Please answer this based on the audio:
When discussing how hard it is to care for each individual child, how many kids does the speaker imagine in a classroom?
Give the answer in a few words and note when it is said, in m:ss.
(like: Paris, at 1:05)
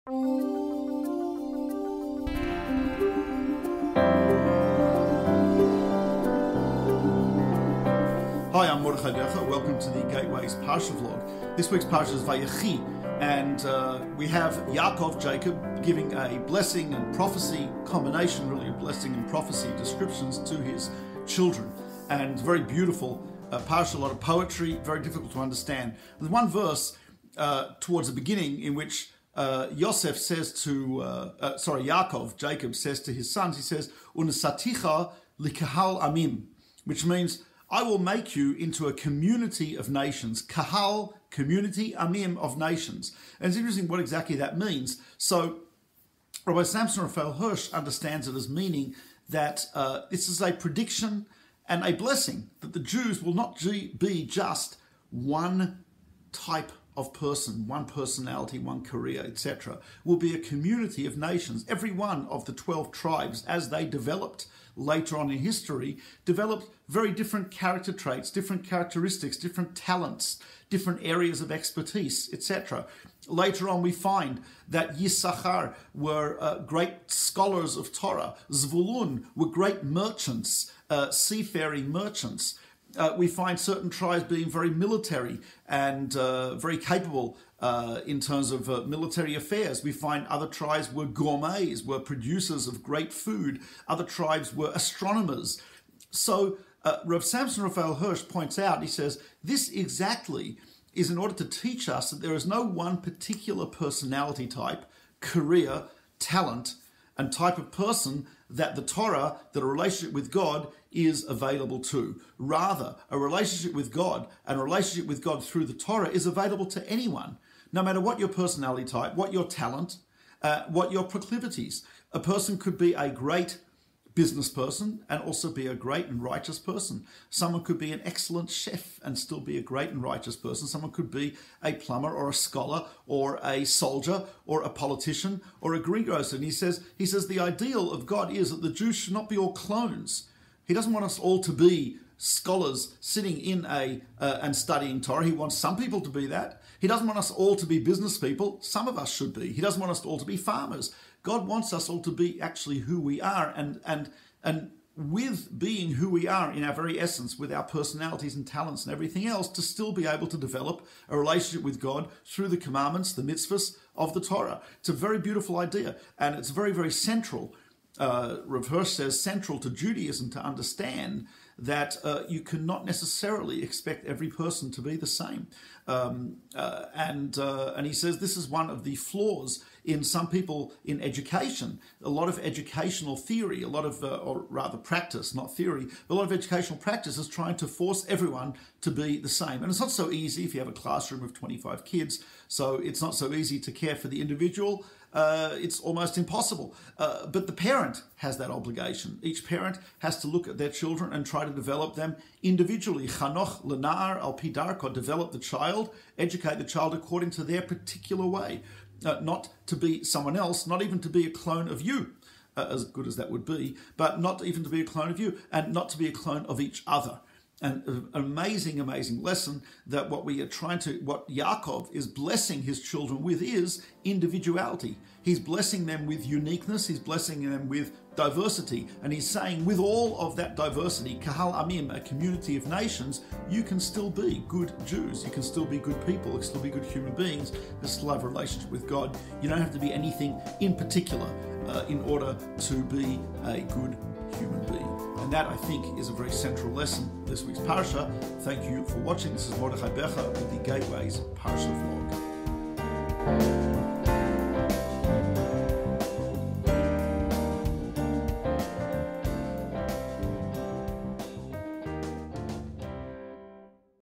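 25, at 3:11.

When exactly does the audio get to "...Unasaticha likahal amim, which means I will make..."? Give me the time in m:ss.
0:34.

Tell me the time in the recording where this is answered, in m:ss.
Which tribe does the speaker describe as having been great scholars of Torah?
1:14.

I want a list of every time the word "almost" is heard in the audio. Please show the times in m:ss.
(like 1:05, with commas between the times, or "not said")
3:15.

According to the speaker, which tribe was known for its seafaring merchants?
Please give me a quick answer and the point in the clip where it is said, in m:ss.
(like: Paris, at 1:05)
Zvulun, at 1:18.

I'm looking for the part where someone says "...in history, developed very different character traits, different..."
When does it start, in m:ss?
1:05.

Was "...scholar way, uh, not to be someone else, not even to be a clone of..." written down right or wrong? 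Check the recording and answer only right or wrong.
wrong.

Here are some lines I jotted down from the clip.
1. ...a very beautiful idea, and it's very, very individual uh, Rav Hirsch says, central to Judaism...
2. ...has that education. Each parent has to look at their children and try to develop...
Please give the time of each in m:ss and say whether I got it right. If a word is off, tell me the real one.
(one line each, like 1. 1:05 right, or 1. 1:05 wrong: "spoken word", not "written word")
1. 2:44 wrong: "central", not "individual"
2. 3:18 wrong: "obligation", not "education".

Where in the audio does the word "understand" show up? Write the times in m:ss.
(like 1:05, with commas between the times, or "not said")
0:25, 0:47, 2:50.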